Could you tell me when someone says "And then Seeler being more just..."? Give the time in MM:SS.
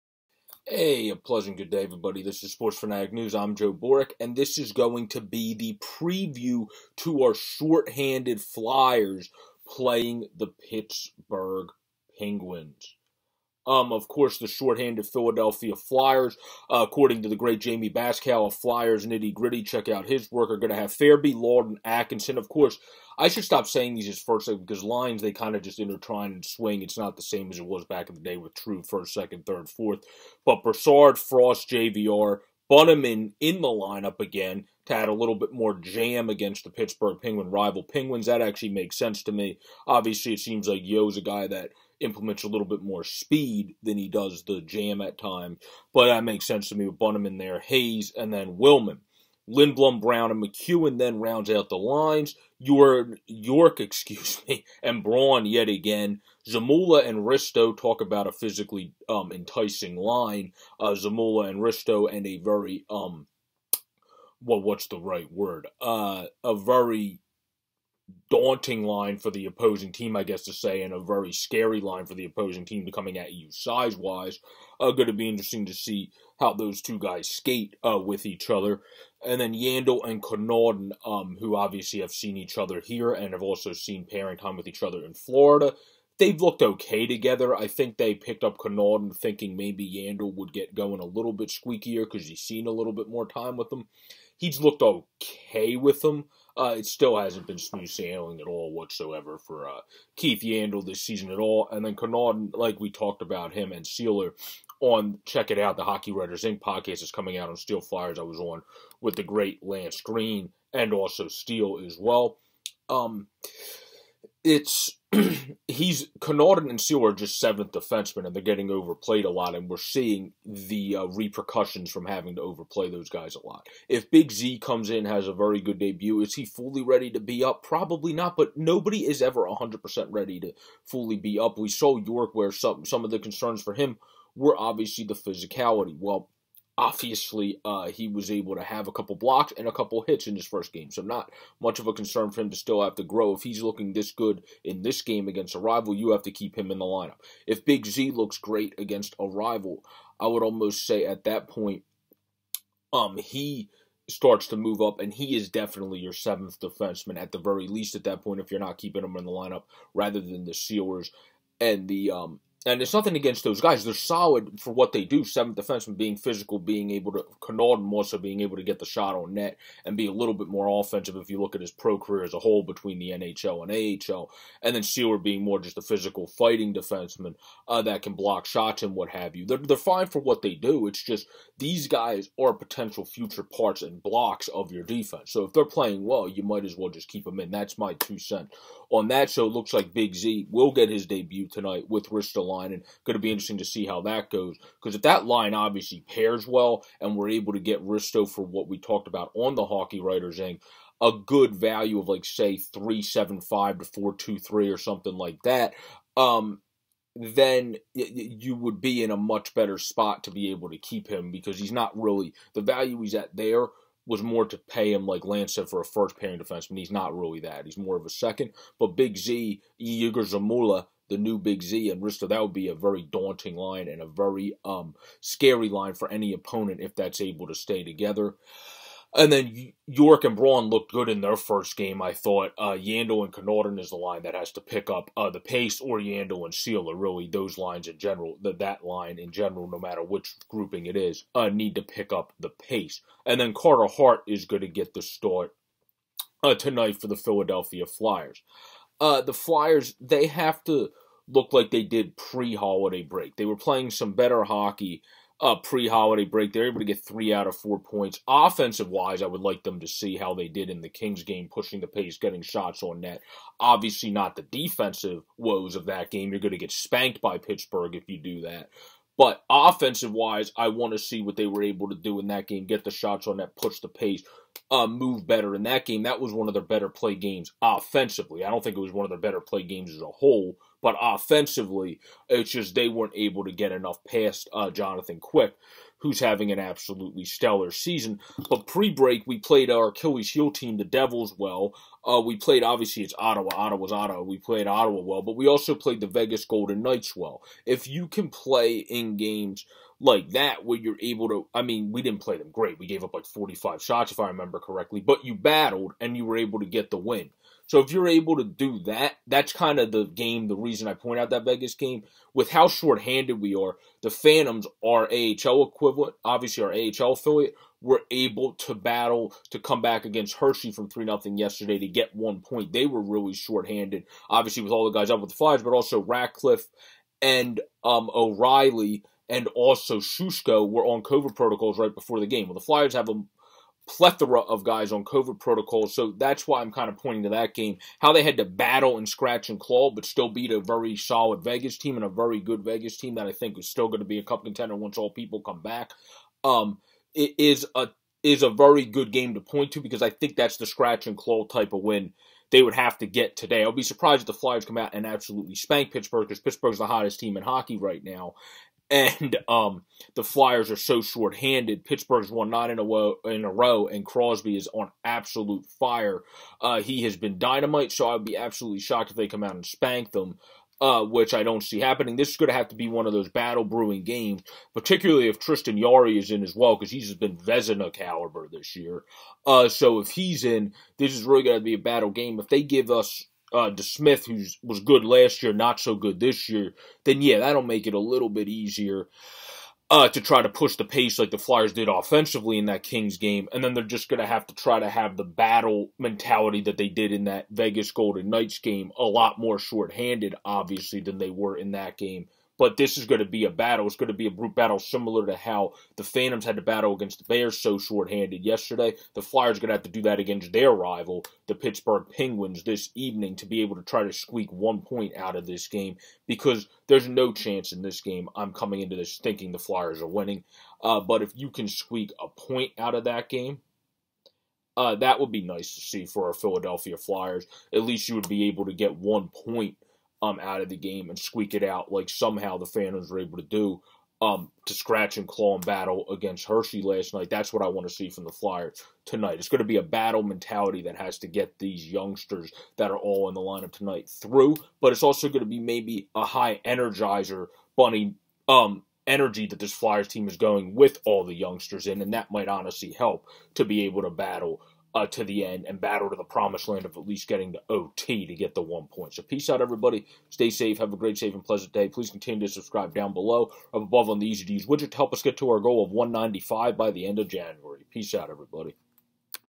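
02:54.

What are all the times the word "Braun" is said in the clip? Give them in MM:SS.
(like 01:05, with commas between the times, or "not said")
00:55, 03:50.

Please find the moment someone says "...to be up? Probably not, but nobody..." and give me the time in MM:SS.
02:07.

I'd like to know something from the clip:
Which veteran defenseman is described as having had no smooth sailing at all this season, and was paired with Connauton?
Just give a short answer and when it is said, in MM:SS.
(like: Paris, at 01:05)
Keith Yandle, at 01:40.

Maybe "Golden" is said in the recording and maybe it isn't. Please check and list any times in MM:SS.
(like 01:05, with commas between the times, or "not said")
04:56, 06:37.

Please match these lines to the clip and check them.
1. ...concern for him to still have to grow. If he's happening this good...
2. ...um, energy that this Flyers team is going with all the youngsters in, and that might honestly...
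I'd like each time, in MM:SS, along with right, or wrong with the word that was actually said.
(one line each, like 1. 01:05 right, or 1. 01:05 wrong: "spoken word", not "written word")
1. 02:21 wrong: "looking", not "happening"
2. 07:28 right.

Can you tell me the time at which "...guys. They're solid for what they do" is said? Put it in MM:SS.
02:43.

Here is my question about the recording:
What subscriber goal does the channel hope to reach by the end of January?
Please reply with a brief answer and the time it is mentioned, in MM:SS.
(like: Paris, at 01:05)
195, at 07:45.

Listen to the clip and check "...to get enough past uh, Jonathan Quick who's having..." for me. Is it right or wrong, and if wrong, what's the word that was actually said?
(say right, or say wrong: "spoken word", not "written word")
right.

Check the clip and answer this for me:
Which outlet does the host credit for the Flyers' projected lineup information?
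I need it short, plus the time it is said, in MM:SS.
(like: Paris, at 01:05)
Flyers Nitty Gritty, at 00:18.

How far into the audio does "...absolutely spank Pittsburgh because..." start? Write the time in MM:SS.
05:55.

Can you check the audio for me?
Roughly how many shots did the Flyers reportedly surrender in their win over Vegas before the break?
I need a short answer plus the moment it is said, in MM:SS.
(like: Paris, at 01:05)
45, at 05:03.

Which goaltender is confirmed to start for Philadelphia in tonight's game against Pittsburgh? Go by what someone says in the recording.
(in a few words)
Carter Hart.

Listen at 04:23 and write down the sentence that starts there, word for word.
Obviously, not the defensive woes of that game.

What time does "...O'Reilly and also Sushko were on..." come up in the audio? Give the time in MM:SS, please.
05:28.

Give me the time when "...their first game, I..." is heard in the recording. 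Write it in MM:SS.
03:51.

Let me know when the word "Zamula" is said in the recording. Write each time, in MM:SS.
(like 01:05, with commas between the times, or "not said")
00:56, 01:00, 03:40.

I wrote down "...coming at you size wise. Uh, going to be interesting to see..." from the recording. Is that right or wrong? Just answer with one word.
right.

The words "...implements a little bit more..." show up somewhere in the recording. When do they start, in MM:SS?
00:42.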